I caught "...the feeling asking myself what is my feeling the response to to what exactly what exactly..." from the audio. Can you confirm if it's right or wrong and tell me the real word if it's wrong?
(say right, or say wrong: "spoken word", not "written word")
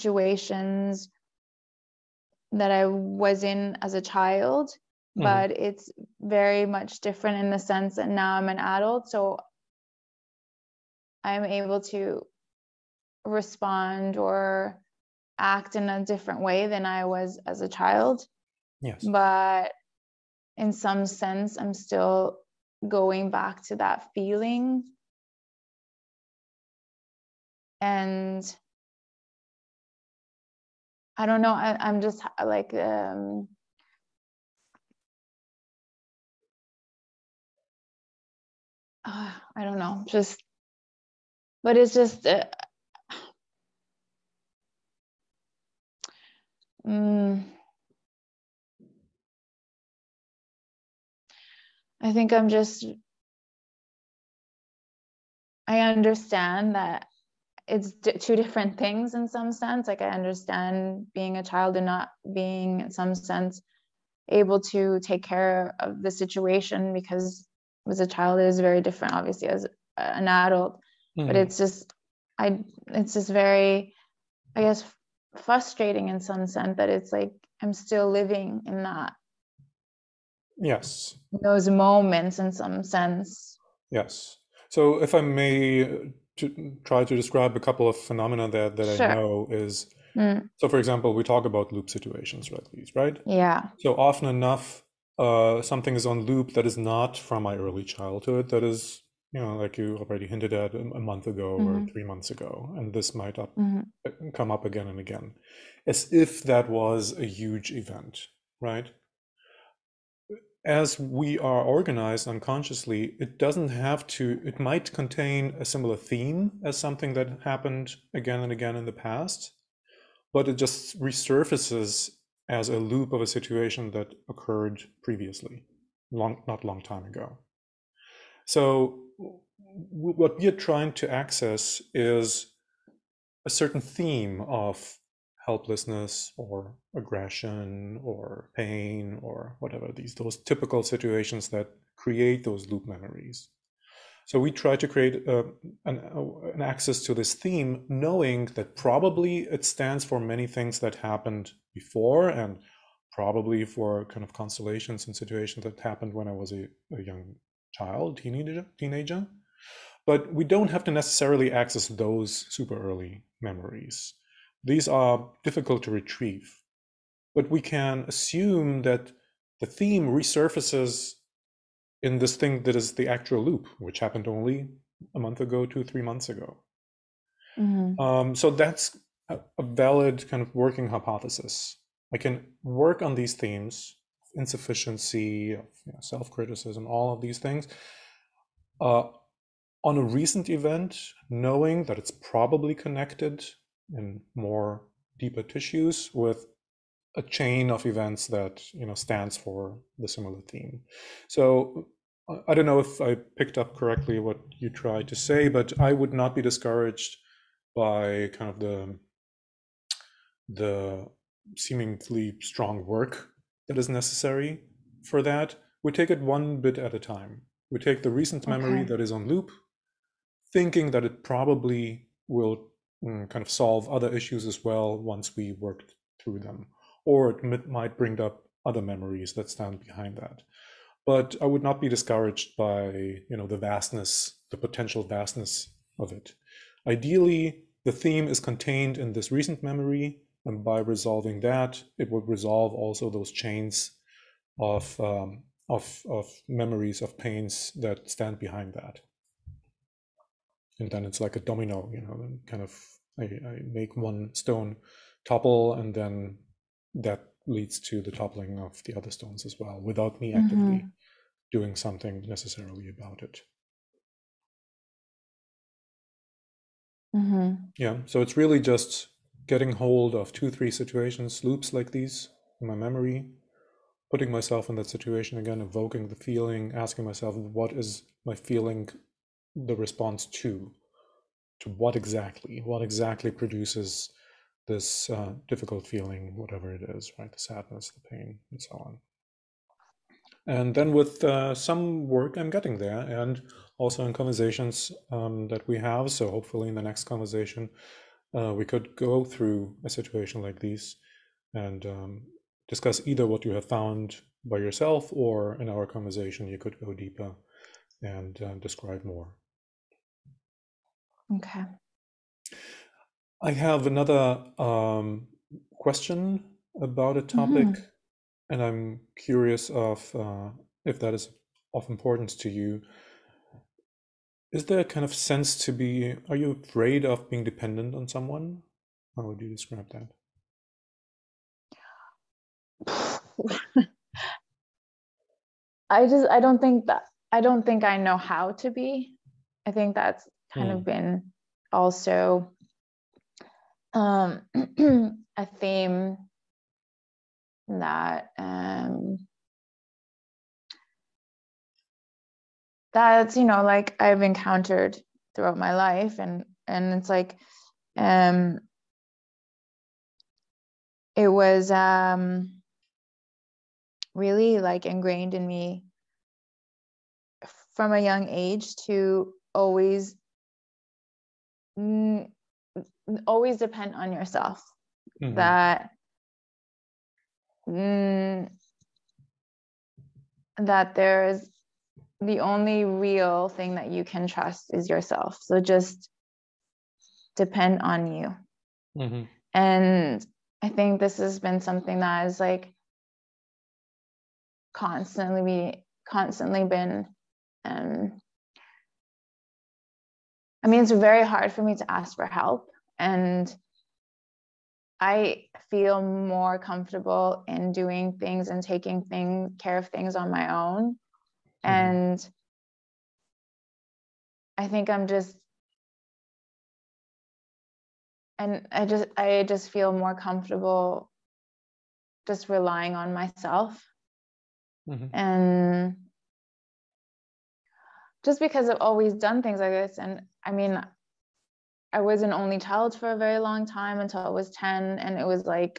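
right.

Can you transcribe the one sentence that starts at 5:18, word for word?
and I'm curious of uh, if that is of importance to you.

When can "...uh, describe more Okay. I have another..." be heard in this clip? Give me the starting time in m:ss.
5:08.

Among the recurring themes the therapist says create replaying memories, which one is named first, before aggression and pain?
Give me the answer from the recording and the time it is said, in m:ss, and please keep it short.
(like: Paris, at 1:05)
helplessness, at 2:15.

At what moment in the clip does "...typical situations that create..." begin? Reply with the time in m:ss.
2:20.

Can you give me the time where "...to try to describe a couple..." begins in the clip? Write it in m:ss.
1:26.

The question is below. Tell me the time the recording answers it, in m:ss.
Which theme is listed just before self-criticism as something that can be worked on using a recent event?
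3:04.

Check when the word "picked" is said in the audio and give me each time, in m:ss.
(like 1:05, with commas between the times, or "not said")
3:23.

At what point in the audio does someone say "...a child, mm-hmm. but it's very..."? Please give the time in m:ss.
0:03.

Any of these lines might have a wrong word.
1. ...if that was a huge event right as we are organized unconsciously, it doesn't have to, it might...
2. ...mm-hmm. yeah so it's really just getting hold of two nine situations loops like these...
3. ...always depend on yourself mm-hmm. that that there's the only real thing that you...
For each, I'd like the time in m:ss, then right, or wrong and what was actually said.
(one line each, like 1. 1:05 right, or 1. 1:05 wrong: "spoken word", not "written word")
1. 1:46 right
2. 4:27 wrong: "three", not "nine"
3. 6:13 right.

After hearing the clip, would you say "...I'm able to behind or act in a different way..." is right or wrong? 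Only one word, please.
wrong.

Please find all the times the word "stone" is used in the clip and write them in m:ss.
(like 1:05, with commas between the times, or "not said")
4:14, 4:19.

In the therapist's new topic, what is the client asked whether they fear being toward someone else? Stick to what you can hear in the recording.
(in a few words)
dependent.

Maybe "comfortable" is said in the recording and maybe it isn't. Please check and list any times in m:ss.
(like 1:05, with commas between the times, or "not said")
6:46, 7:00.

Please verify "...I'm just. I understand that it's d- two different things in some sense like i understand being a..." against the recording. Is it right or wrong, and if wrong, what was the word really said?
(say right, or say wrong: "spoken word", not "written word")
right.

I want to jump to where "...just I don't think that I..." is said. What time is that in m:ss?
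5:36.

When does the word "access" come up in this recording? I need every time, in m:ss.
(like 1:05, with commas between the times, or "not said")
2:11, 2:26, 2:41.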